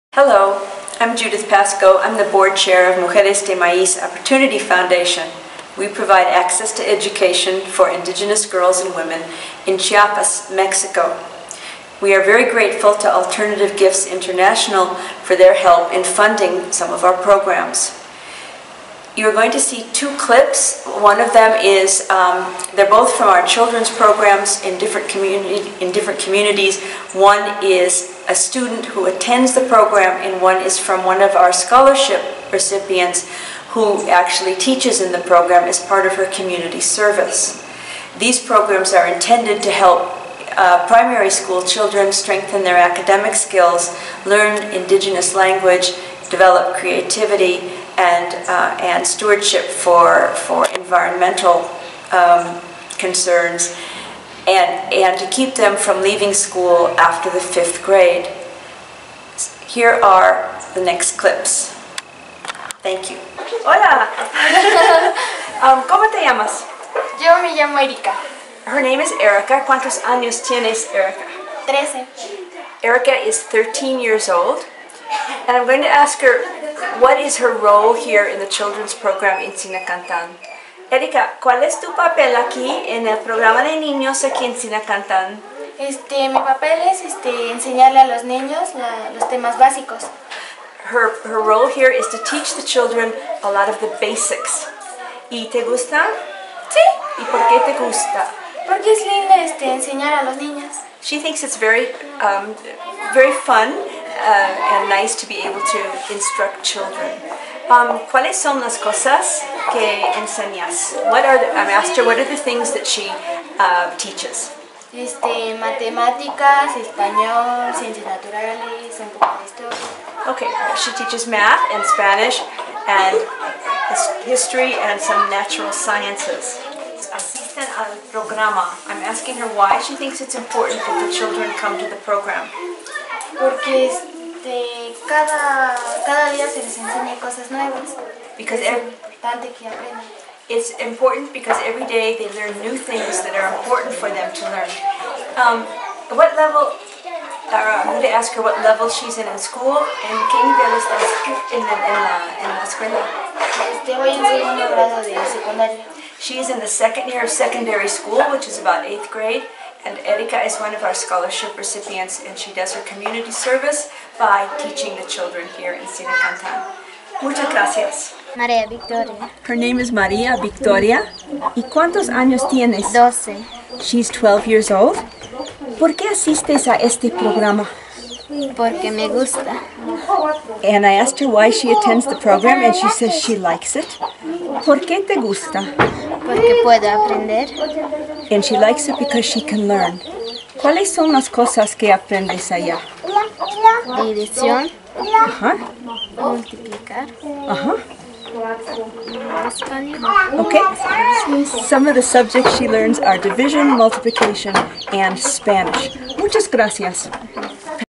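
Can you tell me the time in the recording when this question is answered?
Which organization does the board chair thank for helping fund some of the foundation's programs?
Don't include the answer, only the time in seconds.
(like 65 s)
13 s.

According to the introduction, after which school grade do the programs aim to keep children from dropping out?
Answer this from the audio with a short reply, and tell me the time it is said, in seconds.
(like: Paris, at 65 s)
fifth grade, at 57 s.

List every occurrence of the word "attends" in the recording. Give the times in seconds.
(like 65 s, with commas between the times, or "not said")
29 s, 181 s.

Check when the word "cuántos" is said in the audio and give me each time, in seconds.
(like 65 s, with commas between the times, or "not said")
69 s, 171 s.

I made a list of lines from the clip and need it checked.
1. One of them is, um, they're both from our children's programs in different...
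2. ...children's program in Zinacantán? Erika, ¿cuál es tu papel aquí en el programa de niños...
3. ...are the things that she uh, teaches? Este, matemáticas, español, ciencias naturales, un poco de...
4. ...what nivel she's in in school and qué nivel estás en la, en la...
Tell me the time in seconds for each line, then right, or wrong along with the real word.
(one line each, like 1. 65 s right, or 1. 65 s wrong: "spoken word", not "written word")
1. 20 s right
2. 78 s right
3. 112 s right
4. 148 s wrong: "level", not "nivel".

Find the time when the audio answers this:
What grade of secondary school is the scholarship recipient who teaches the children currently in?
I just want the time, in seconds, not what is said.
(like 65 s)
156 s.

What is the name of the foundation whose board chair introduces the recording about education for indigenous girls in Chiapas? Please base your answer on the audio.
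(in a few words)
Mujeres de Maíz Opportunity Foundation.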